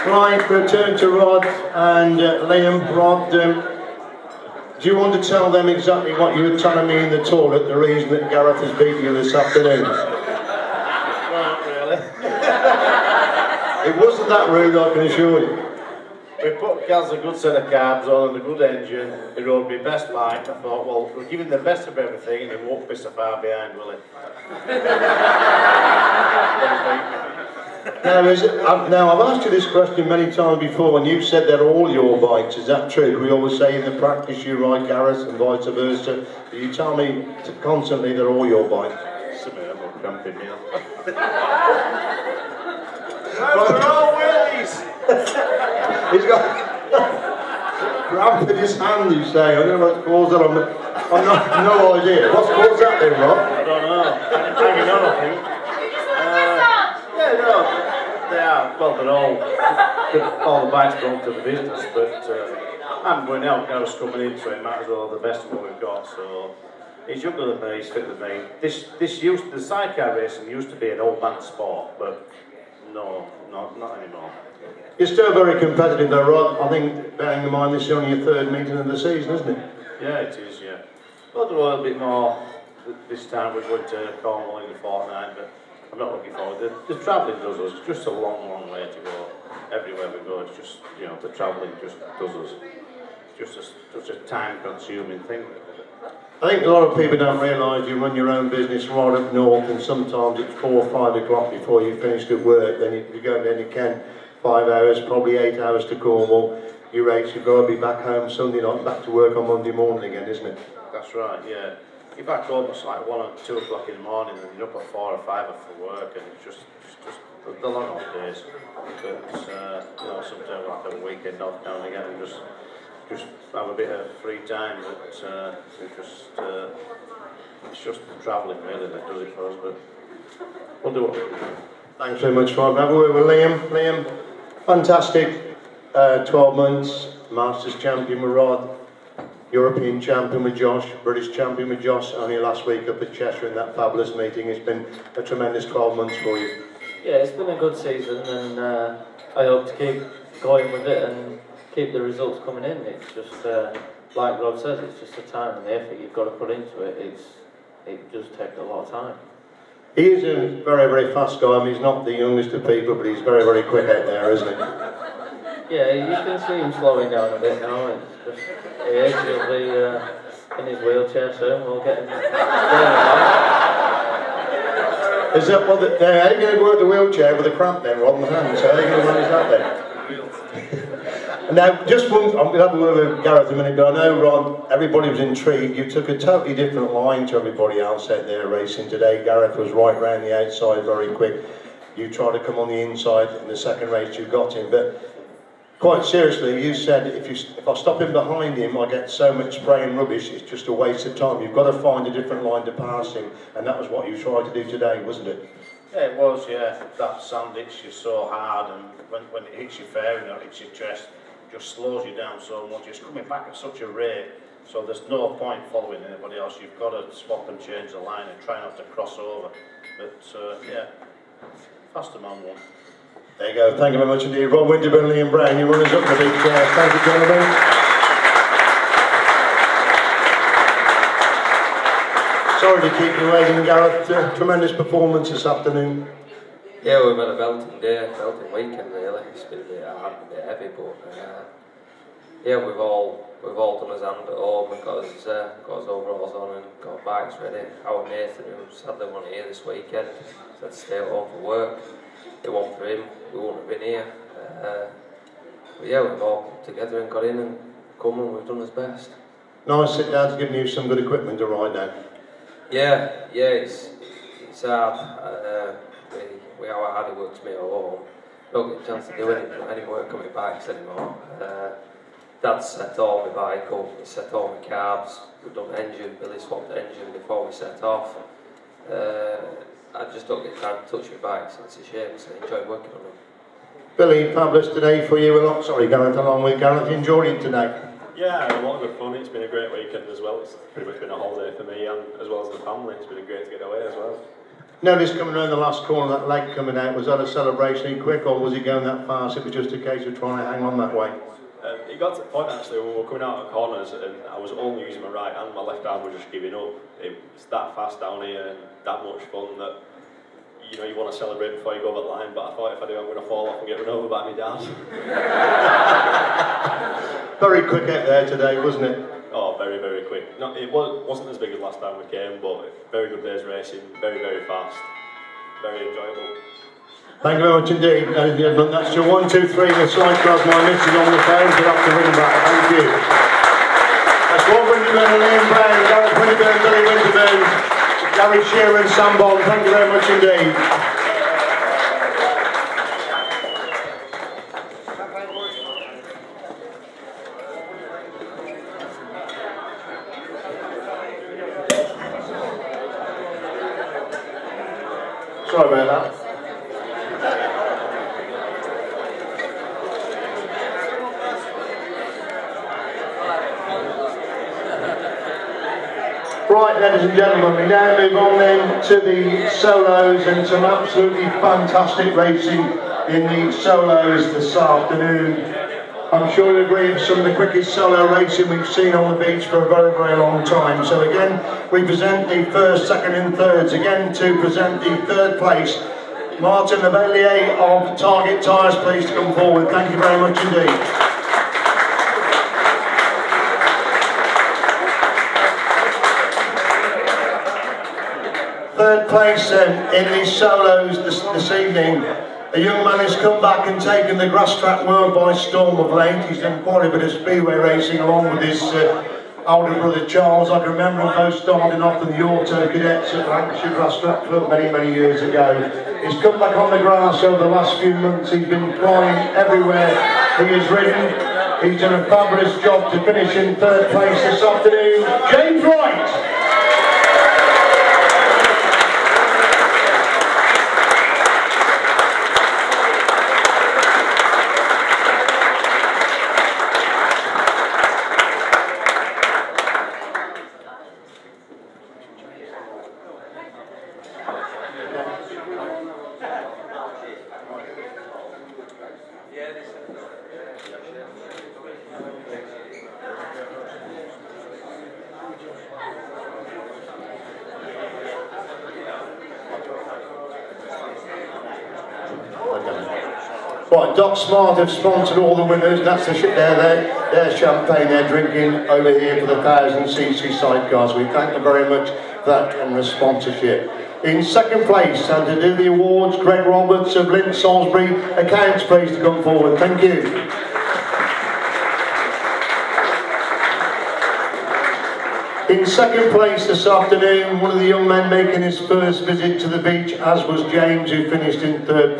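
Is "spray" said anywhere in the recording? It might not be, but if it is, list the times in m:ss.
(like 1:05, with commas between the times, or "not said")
3:19.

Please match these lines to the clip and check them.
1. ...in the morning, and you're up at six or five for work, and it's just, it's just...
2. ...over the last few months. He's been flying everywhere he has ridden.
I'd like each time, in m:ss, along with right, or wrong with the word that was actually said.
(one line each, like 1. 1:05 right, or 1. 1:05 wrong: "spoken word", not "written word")
1. 1:53 wrong: "four", not "six"
2. 6:57 right.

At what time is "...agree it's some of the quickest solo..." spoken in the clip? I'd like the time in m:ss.
6:16.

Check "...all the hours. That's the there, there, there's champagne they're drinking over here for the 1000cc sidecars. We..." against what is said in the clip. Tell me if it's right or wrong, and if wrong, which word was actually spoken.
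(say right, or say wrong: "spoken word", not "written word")
wrong: "winners", not "hours".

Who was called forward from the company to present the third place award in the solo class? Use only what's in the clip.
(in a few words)
Martin Lavellier.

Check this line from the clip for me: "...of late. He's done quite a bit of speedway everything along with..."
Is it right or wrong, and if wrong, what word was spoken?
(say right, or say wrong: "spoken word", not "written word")
wrong: "racing", not "everything".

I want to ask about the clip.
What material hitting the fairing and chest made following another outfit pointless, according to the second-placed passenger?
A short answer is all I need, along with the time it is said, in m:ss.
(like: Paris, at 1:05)
Sand, at 3:27.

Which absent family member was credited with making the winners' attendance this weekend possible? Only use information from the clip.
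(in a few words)
Nathan.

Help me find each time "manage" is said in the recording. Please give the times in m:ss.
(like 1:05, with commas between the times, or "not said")
2:59.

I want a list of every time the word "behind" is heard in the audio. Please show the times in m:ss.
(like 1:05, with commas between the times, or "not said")
0:23, 3:18.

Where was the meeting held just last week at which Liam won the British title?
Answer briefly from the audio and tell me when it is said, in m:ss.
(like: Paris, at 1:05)
Cheshire, at 2:23.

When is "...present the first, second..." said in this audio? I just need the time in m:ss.
6:21.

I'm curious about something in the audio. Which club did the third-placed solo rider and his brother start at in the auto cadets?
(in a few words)
Lancashire Grass Track Club.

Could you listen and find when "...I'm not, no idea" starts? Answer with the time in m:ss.
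0:51.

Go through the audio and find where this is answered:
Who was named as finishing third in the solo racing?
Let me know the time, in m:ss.
7:05.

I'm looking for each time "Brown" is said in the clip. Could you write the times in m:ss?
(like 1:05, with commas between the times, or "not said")
3:45, 5:35.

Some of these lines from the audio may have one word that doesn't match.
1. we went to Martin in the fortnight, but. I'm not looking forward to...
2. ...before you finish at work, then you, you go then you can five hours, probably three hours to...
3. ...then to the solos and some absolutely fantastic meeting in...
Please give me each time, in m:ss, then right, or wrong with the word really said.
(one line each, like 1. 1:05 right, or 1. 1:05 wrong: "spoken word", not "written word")
1. 1:23 wrong: "Cornwall", not "Martin"
2. 1:41 wrong: "eight", not "three"
3. 6:08 wrong: "racing", not "meeting".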